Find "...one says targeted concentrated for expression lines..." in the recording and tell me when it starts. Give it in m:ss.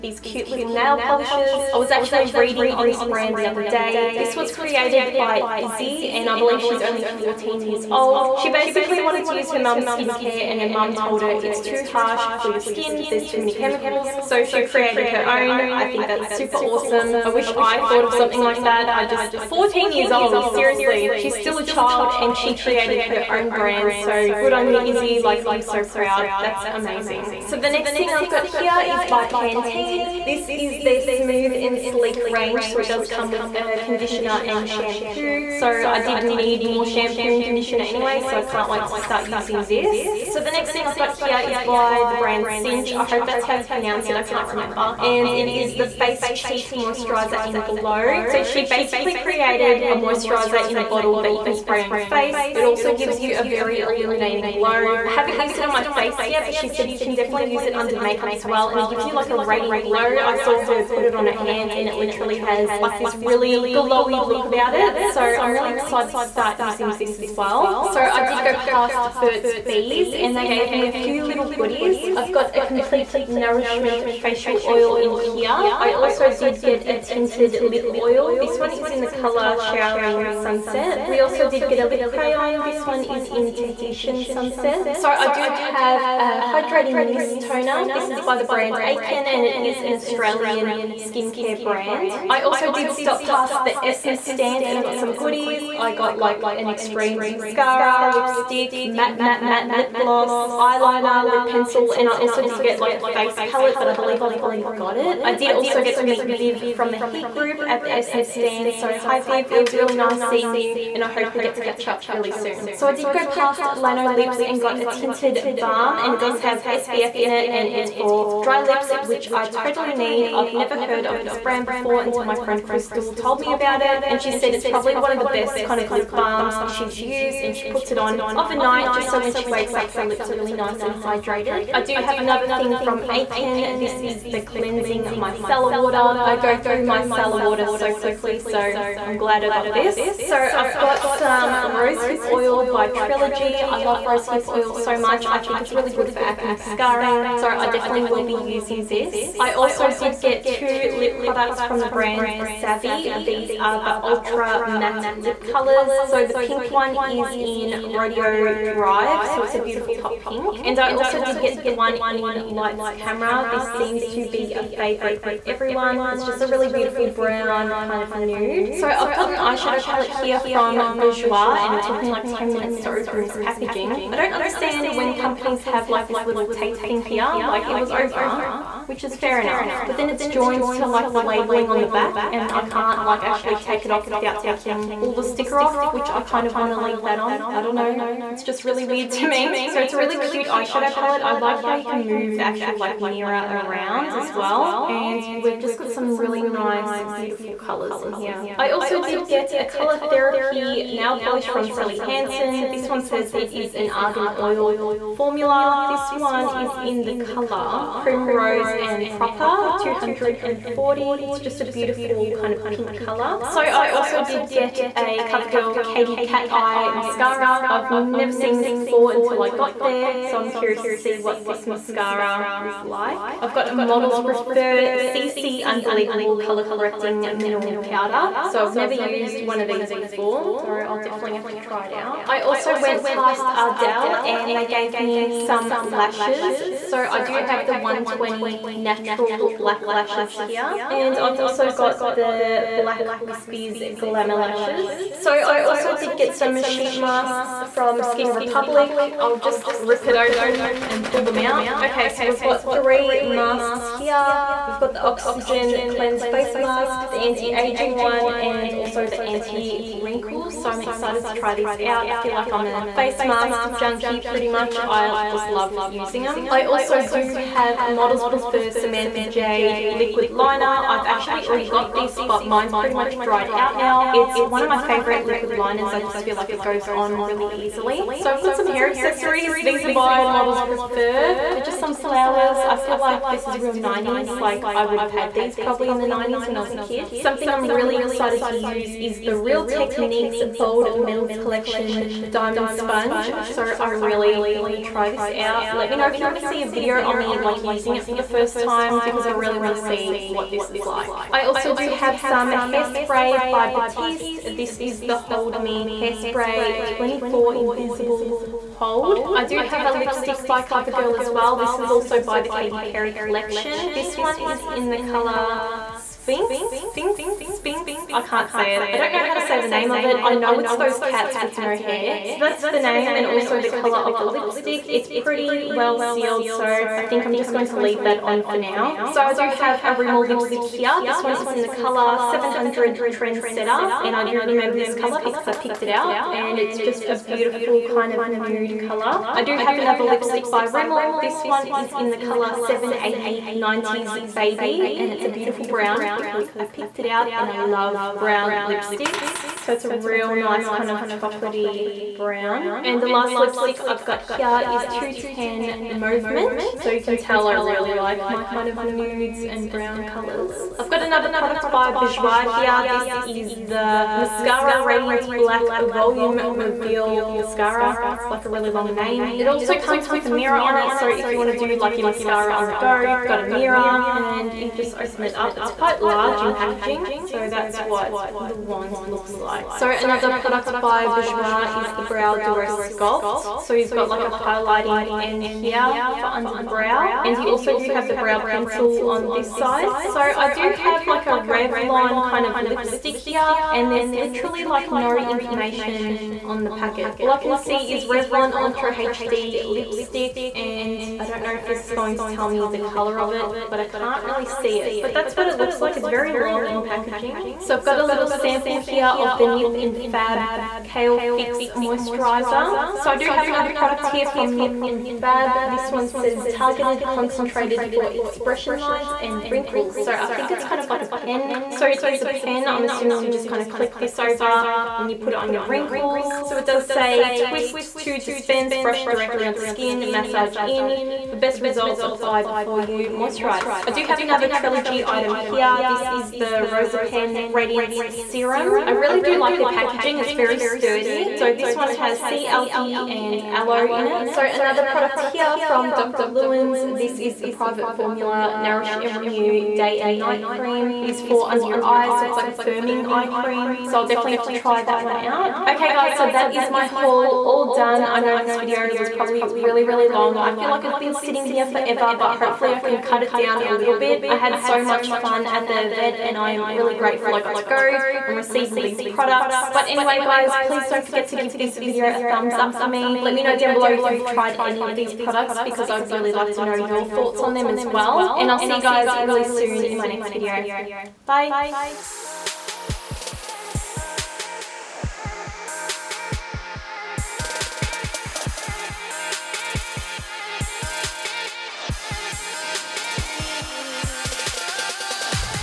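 6:55.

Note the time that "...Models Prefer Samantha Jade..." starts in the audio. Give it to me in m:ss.
4:27.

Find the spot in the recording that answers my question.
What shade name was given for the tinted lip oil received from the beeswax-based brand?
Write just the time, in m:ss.
1:19.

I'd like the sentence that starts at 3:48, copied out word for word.
So I've never used one of these before.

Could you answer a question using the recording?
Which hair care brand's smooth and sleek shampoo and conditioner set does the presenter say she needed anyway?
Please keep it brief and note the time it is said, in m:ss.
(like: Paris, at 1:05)
Pantene, at 0:29.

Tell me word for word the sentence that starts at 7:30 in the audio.
It is for under your eyes.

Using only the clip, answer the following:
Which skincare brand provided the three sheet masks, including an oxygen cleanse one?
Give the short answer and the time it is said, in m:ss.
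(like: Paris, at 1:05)
Skin Republic, at 4:08.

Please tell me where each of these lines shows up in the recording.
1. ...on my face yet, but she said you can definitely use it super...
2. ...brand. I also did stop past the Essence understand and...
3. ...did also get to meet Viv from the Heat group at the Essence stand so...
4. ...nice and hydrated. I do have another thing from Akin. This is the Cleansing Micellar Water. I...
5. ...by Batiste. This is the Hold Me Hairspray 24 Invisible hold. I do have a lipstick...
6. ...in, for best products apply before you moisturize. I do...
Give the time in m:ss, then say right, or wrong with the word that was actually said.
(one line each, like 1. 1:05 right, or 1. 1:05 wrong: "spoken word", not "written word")
1. 0:55 wrong: "under", not "super"
2. 1:31 wrong: "stand", not "understand"
3. 1:45 right
4. 2:10 right
5. 5:03 right
6. 7:10 wrong: "results", not "products".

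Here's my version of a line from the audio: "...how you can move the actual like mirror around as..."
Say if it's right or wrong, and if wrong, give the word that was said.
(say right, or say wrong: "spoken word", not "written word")
right.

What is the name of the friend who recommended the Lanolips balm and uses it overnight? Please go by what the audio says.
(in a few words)
Crystal.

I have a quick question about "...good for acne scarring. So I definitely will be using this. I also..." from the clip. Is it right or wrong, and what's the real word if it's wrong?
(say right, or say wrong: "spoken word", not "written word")
right.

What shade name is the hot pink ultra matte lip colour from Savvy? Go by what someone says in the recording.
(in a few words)
Rodeo Drive.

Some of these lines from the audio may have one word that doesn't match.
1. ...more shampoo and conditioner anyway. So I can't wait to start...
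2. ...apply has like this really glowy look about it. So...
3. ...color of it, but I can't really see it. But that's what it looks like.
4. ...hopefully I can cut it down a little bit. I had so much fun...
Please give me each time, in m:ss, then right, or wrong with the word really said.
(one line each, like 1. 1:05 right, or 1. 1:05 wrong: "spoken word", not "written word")
1. 0:36 right
2. 1:01 wrong: "literally", not "apply"
3. 6:42 right
4. 7:42 right.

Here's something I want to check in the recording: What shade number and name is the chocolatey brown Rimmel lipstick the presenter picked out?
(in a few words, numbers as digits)
780 90s Baby.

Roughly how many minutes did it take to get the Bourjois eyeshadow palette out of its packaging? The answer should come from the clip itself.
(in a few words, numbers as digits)
10.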